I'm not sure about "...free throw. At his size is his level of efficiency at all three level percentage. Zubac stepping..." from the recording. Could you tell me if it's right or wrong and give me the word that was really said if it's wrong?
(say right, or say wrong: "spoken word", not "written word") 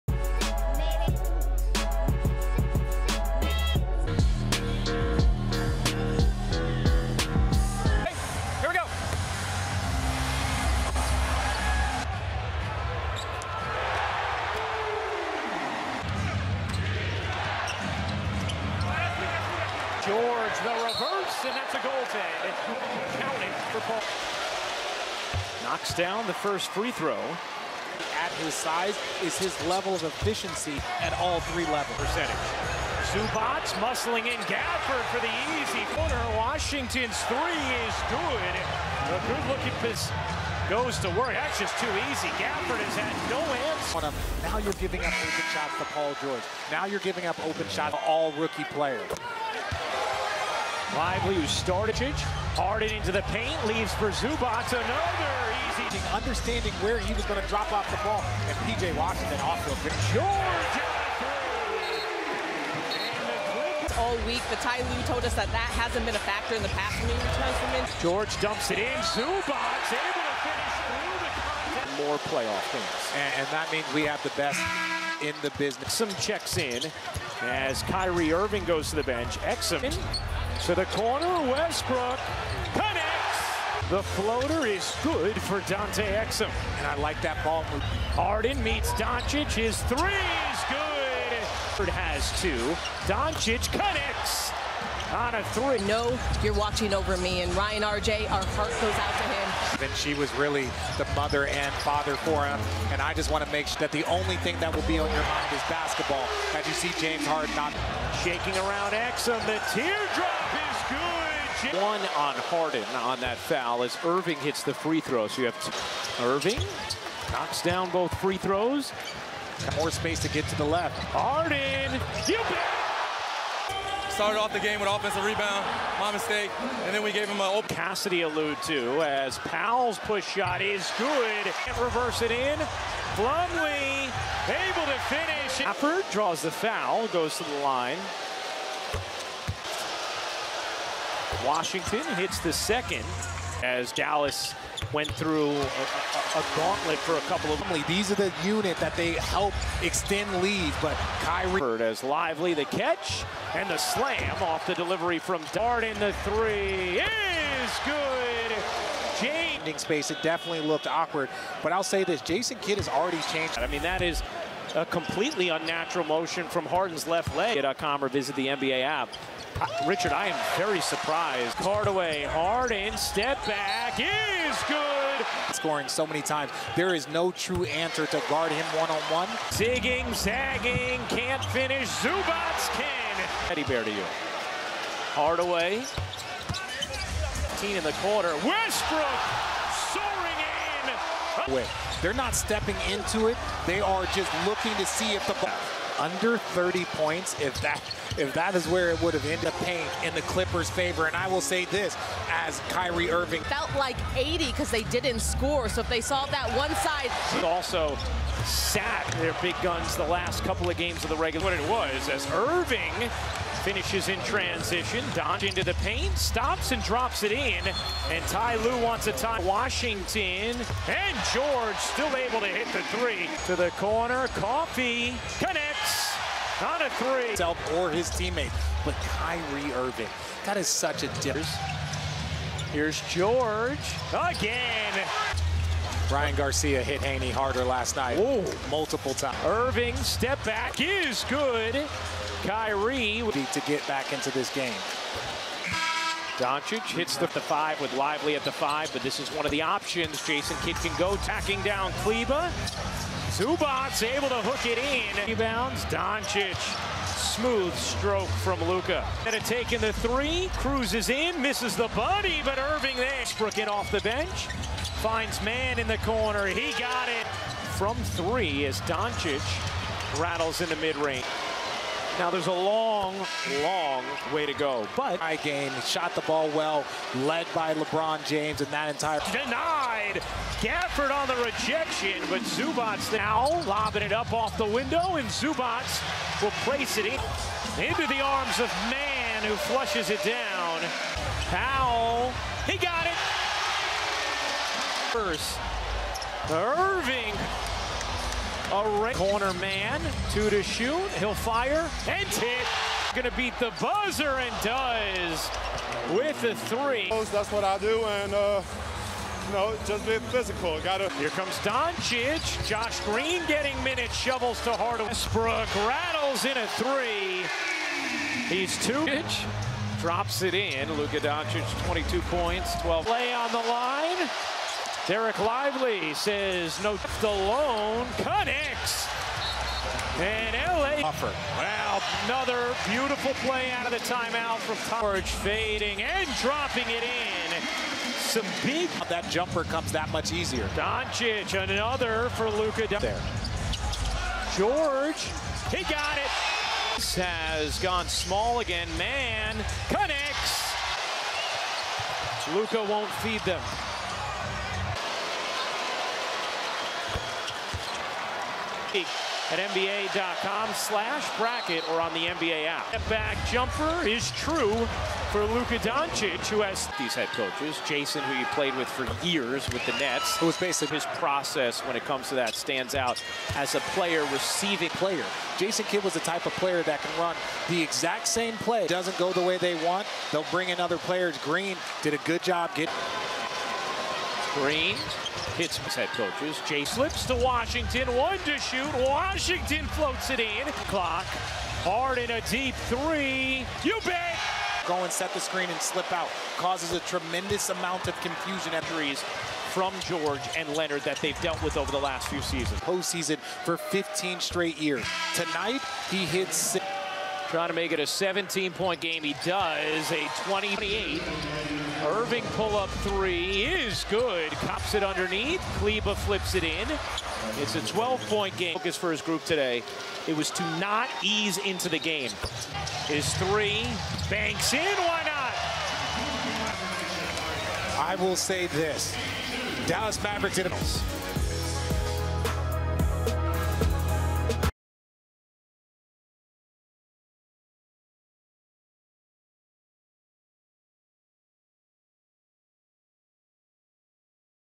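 wrong: "muscling", not "stepping".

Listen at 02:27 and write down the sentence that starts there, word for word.
These are the unit that they help extend lead.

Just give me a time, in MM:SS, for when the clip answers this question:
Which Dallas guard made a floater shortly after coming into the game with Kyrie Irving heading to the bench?
01:25.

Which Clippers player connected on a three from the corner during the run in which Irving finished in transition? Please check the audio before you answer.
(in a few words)
Coffey.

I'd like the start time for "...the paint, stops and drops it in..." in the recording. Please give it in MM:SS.
03:35.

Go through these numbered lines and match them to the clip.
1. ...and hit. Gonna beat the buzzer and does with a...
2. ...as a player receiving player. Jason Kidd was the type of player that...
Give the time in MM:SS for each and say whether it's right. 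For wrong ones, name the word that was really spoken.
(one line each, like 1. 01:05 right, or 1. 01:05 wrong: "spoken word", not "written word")
1. 05:02 right
2. 06:13 right.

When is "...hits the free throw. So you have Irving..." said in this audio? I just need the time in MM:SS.
01:54.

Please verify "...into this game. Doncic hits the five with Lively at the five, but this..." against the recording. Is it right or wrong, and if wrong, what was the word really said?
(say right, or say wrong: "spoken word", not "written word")
right.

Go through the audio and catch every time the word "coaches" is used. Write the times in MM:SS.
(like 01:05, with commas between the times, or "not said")
06:07, 06:26.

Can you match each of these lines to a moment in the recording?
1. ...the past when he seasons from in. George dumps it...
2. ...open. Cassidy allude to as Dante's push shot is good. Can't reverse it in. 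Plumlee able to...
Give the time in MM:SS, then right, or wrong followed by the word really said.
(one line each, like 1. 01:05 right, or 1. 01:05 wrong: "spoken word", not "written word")
1. 01:06 wrong: "returns", not "seasons"
2. 02:07 wrong: "Powell", not "Dante".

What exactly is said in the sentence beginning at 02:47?
Get.com or visit the NBA app.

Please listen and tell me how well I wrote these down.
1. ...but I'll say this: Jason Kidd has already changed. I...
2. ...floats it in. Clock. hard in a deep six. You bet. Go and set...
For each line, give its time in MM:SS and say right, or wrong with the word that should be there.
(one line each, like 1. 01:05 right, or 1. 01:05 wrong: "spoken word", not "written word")
1. 02:41 right
2. 06:29 wrong: "three", not "six".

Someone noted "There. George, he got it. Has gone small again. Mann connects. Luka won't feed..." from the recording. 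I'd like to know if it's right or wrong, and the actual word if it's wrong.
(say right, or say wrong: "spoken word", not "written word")
right.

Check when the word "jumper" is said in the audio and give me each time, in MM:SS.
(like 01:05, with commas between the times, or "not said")
05:39, 06:03.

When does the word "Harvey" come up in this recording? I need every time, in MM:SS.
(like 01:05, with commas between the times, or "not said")
not said.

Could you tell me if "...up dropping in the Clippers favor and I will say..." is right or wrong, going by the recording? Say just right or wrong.
wrong.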